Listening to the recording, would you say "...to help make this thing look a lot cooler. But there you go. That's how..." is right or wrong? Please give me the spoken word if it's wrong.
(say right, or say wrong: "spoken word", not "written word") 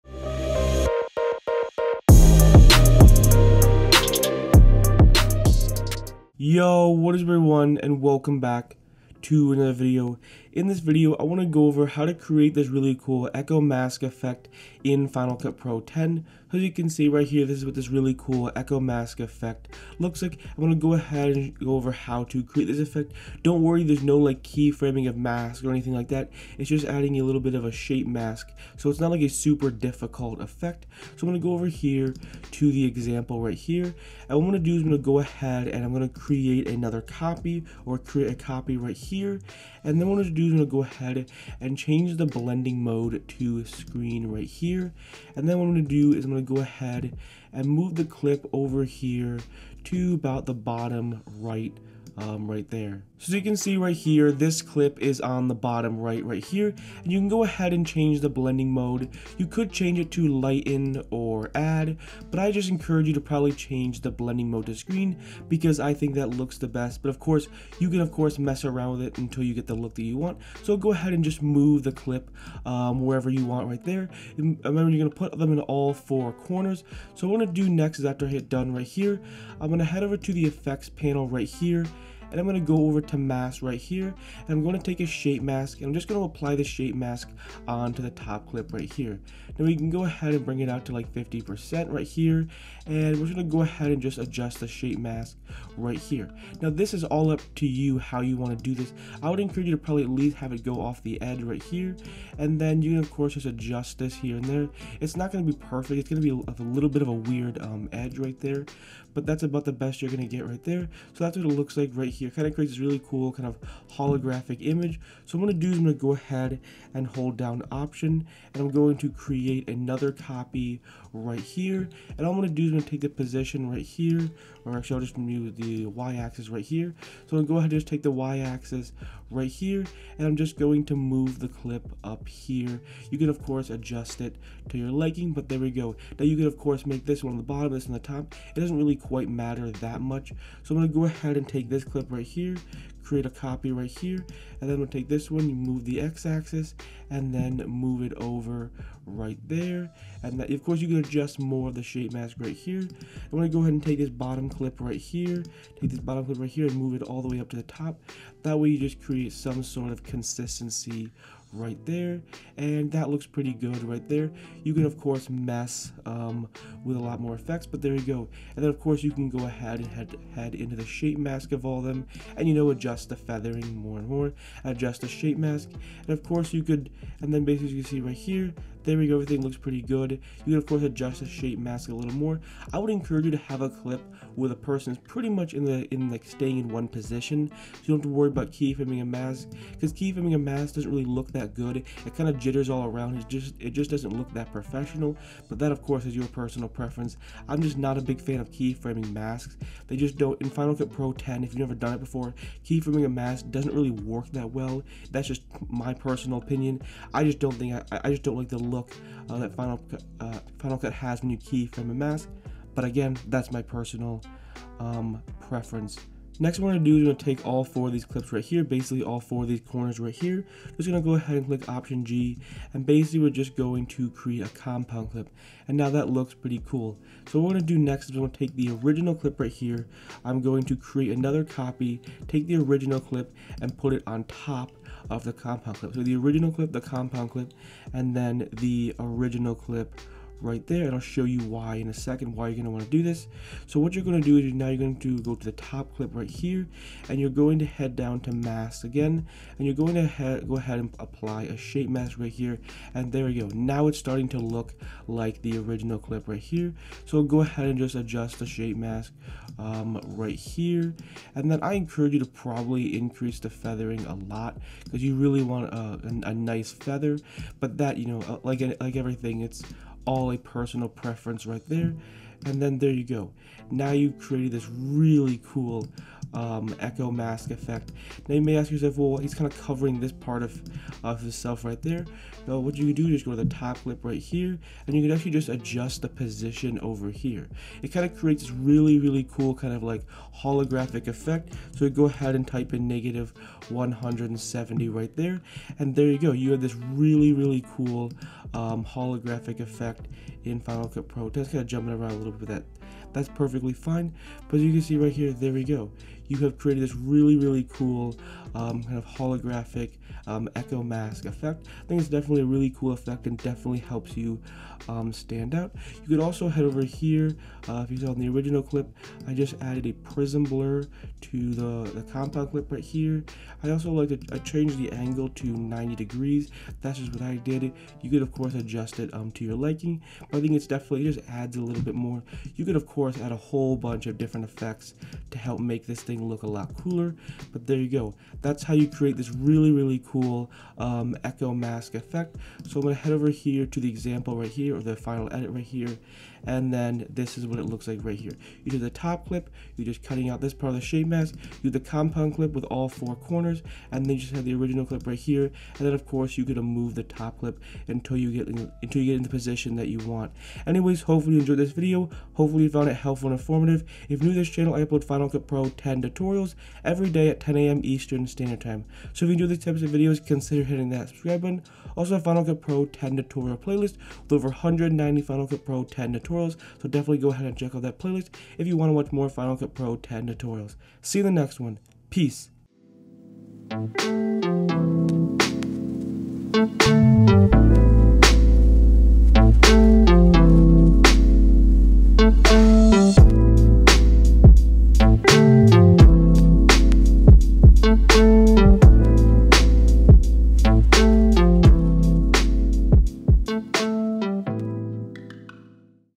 right.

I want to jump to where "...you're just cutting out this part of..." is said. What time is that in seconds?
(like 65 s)
349 s.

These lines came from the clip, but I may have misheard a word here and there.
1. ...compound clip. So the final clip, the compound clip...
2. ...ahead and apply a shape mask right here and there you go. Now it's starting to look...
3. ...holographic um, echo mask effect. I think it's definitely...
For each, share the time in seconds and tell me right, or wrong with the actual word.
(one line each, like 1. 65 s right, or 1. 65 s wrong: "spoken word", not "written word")
1. 235 s wrong: "original", not "final"
2. 250 s right
3. 309 s right.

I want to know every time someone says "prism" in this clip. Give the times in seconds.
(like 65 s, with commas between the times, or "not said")
319 s.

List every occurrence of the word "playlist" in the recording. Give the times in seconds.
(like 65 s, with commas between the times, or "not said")
373 s, 377 s.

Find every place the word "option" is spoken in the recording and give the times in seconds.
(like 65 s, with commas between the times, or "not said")
117 s, 221 s.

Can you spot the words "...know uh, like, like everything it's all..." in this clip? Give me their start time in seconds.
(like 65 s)
268 s.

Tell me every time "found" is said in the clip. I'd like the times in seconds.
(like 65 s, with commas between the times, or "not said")
362 s.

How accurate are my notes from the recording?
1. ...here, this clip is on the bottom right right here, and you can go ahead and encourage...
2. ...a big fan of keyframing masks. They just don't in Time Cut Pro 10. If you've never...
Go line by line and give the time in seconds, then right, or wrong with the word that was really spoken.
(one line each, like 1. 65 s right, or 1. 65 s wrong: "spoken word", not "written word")
1. 53 s wrong: "change", not "encourage"
2. 197 s wrong: "Final", not "Time".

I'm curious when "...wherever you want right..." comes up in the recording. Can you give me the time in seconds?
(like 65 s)
73 s.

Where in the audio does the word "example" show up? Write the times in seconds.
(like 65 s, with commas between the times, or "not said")
32 s, 343 s.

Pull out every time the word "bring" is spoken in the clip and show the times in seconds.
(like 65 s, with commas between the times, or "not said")
90 s.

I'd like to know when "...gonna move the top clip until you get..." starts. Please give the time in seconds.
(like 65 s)
356 s.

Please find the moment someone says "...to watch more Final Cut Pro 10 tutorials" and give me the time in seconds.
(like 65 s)
378 s.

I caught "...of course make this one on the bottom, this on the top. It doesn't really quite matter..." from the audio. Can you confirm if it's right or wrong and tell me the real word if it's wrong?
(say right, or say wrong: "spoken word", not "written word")
right.